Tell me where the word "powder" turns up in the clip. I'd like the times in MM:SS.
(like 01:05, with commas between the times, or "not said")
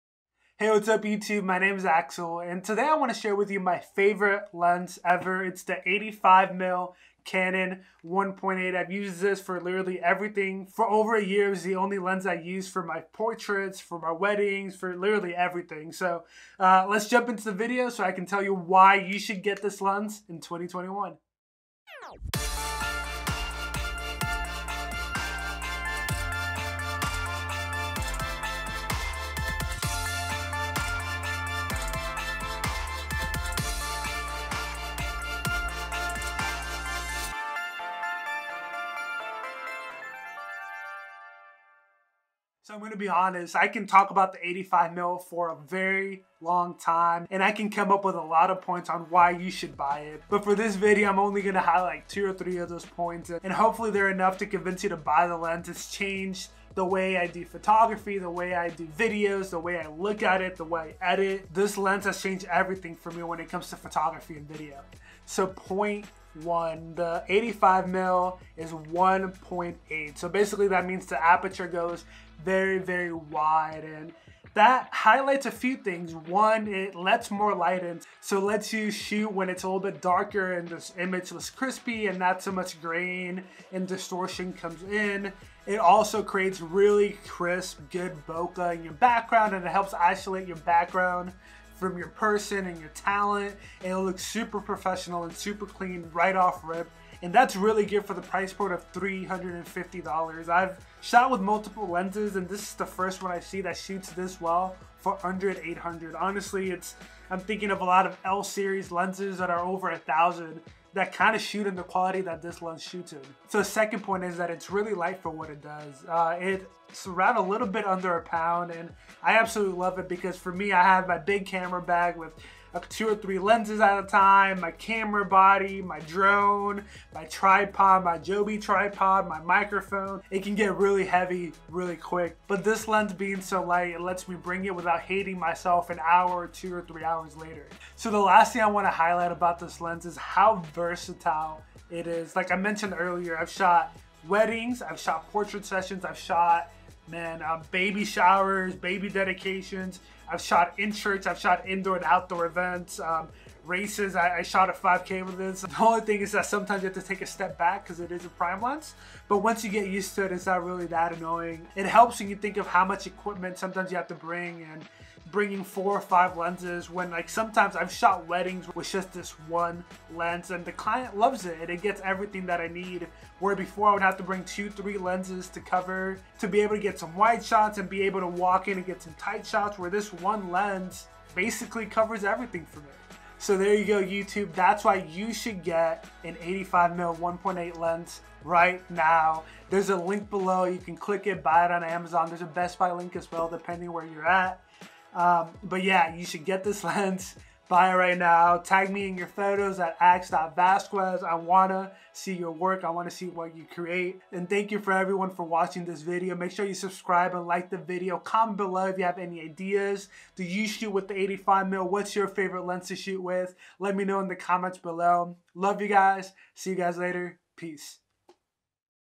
not said.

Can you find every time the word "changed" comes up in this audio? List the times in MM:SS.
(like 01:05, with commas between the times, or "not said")
00:55, 01:02.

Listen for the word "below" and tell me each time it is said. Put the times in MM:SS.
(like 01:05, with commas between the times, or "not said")
03:10, 03:28, 03:34.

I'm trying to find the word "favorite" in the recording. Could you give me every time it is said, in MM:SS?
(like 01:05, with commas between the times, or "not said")
00:03, 03:32.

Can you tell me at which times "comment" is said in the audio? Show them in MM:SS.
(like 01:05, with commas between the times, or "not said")
03:28, 03:34.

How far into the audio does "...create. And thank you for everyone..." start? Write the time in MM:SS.
03:23.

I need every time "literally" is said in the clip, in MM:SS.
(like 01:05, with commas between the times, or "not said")
00:09, 00:14.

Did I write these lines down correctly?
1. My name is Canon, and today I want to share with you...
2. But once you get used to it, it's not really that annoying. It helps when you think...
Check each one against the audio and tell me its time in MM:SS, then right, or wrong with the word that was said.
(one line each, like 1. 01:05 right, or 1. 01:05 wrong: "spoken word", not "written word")
1. 00:01 wrong: "Axel", not "Canon"
2. 02:39 right.